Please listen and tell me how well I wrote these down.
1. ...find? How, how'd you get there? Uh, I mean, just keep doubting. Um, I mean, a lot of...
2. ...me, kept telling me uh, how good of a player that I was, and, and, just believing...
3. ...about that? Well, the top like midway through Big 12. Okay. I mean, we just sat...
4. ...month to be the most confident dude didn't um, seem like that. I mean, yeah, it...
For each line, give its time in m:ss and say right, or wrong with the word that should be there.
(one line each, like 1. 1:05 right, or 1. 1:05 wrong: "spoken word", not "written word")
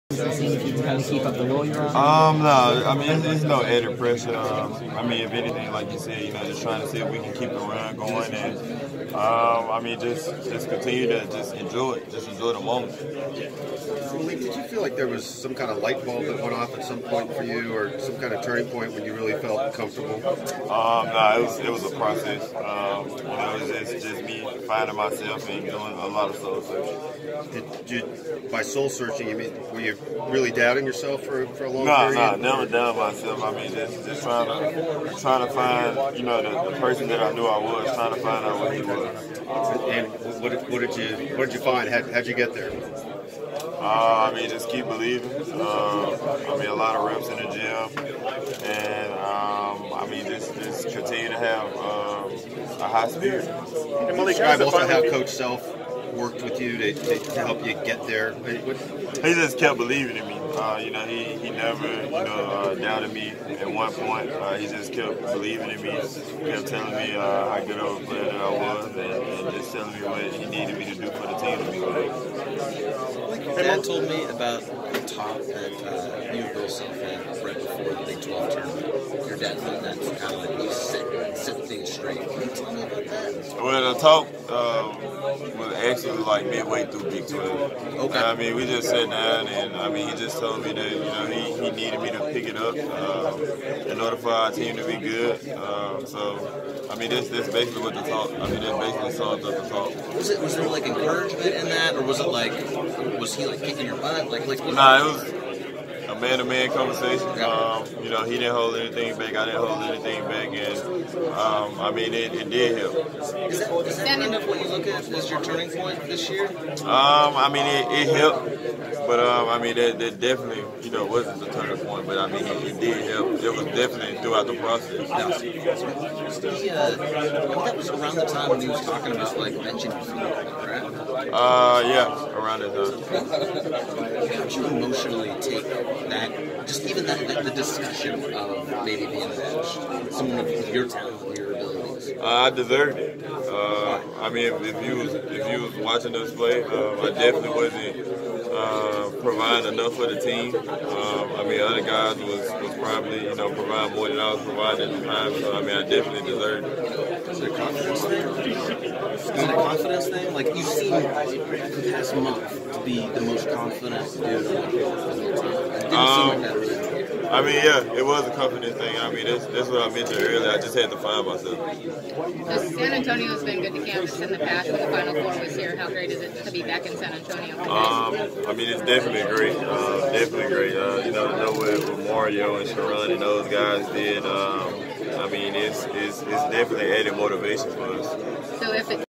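1. 0:41 wrong: "believing", not "doubting"
2. 1:05 wrong: "telling", not "believing"
3. 1:22 right
4. 2:42 right.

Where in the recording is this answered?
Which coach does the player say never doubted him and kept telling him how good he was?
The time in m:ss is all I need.
0:55.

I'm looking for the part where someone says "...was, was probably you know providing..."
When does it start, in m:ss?
2:32.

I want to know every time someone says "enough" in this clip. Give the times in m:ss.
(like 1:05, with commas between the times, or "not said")
2:29.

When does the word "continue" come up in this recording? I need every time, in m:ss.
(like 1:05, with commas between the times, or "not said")
0:10, 0:50.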